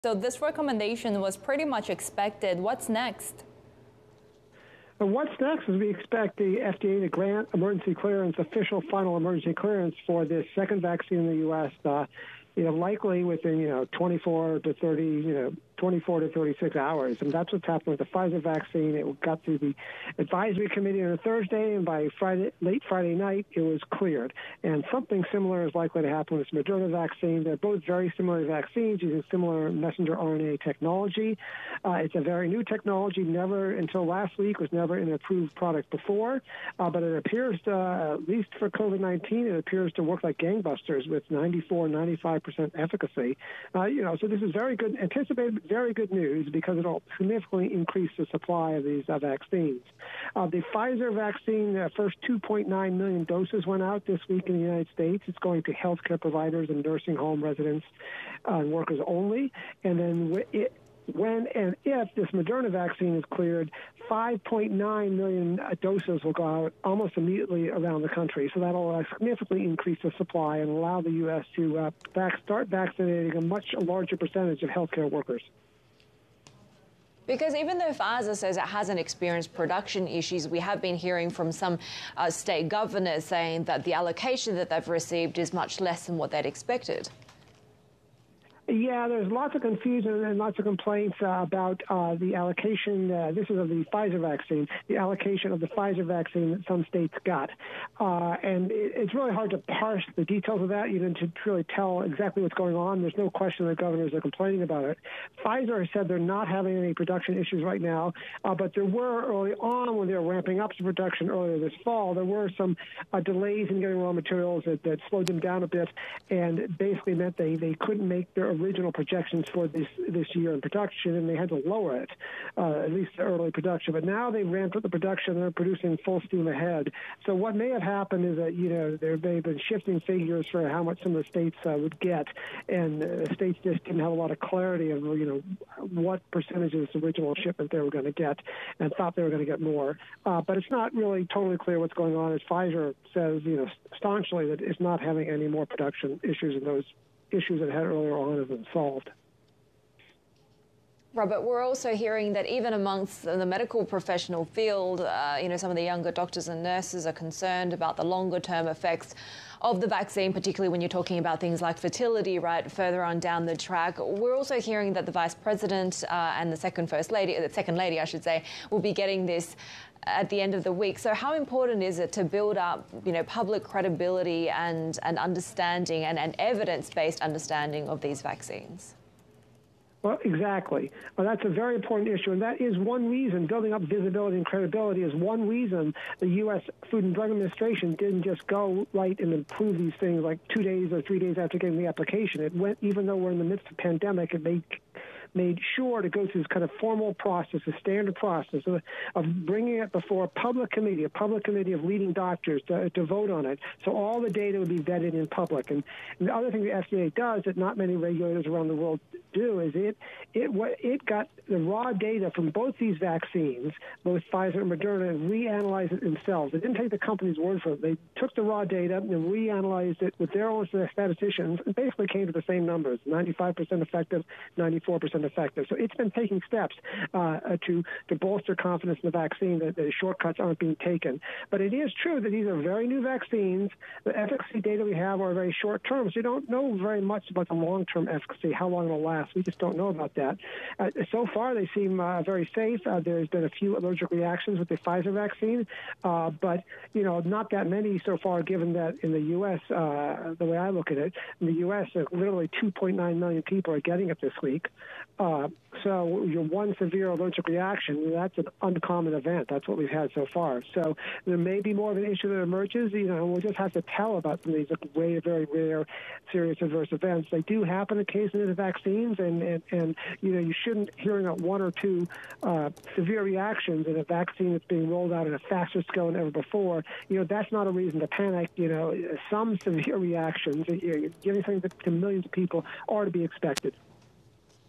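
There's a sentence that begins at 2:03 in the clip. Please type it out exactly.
But now they've ramped up the production; and they're producing full steam ahead.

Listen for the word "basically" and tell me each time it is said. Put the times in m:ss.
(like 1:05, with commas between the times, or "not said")
1:56, 3:41.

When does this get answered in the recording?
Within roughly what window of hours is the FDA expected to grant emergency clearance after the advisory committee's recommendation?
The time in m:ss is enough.
0:15.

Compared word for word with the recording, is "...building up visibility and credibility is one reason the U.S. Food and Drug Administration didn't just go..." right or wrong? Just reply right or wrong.
right.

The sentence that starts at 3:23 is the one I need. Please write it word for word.
So all the data would be vetted in public.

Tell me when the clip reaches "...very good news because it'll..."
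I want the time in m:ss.
0:45.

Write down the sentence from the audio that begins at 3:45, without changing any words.
So it's been taking steps uh, uh, to to bolster confidence in the vaccine that, the shortcuts aren't being taken.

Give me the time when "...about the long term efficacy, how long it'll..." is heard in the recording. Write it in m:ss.
3:57.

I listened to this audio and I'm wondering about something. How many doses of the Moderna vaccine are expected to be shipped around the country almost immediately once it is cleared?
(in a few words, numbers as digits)
5.9 million.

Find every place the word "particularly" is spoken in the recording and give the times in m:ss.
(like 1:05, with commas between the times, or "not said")
2:40.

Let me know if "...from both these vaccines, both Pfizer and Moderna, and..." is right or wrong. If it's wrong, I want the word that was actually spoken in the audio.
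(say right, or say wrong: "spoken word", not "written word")
right.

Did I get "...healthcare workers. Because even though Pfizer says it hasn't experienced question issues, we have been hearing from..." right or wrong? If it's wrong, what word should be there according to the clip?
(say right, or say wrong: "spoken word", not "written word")
wrong: "production", not "question".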